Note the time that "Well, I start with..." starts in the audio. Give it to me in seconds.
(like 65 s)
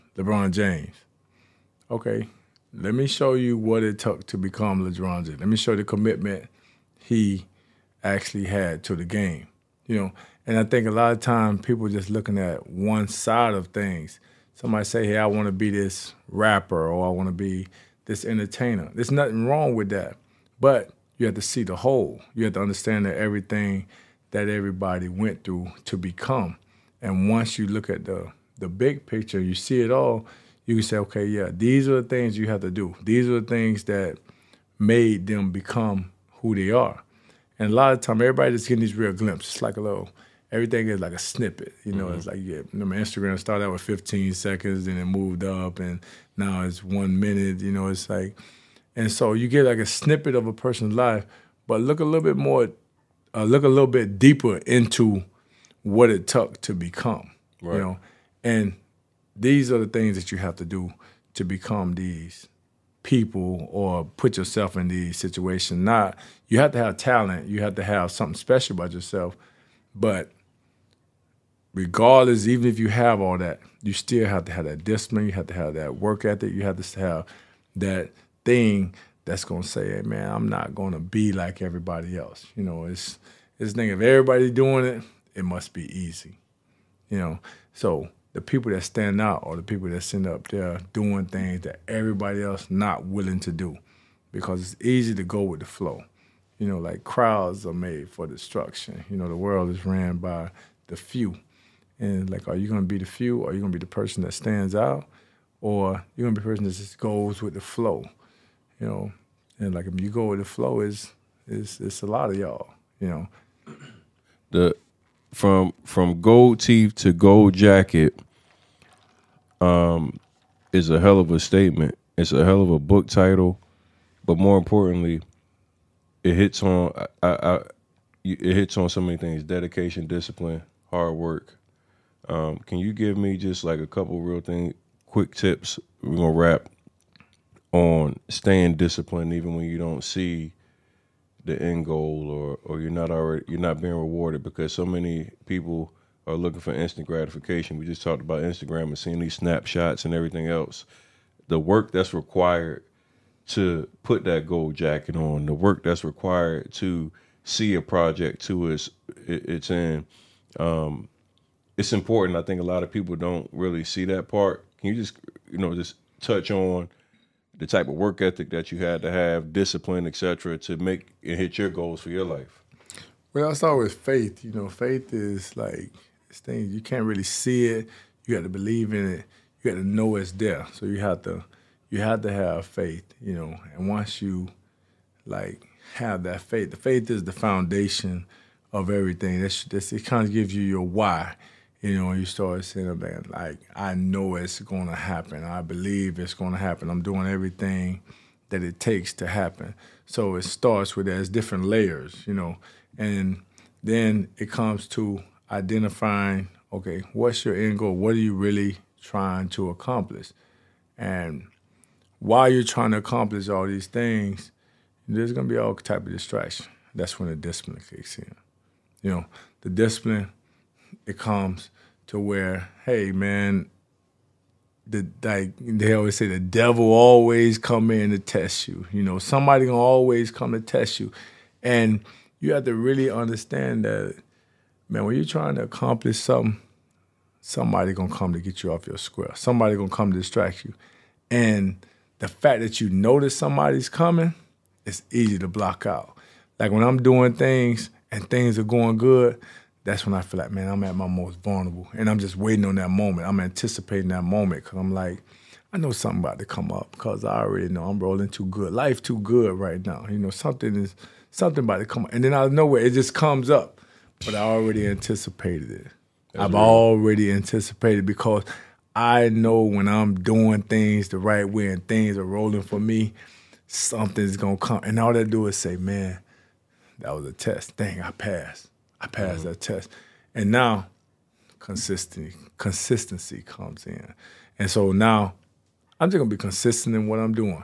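173 s.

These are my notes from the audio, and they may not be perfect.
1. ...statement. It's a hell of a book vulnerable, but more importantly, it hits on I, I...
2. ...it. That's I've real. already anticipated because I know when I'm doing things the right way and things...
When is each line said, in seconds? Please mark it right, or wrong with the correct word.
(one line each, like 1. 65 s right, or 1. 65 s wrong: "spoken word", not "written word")
1. 121 s wrong: "title", not "vulnerable"
2. 265 s right.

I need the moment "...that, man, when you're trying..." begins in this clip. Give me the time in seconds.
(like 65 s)
233 s.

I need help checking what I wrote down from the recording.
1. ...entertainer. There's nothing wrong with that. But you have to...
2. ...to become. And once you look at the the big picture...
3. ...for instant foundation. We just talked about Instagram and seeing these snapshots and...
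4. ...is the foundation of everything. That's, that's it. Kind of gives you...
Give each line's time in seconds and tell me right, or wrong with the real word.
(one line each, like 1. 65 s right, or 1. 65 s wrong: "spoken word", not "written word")
1. 18 s right
2. 25 s right
3. 146 s wrong: "gratification", not "foundation"
4. 187 s right.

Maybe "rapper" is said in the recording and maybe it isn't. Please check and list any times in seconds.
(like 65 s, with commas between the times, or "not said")
16 s.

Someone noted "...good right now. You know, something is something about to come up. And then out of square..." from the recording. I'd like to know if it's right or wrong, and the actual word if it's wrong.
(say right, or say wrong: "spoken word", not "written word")
wrong: "nowhere", not "square".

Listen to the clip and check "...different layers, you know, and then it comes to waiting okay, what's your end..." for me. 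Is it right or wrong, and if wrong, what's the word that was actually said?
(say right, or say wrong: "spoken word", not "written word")
wrong: "identifying", not "waiting".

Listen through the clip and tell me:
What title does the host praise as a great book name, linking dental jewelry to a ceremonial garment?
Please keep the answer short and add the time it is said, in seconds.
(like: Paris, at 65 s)
From Gold Teeth to Gold Jacket, at 115 s.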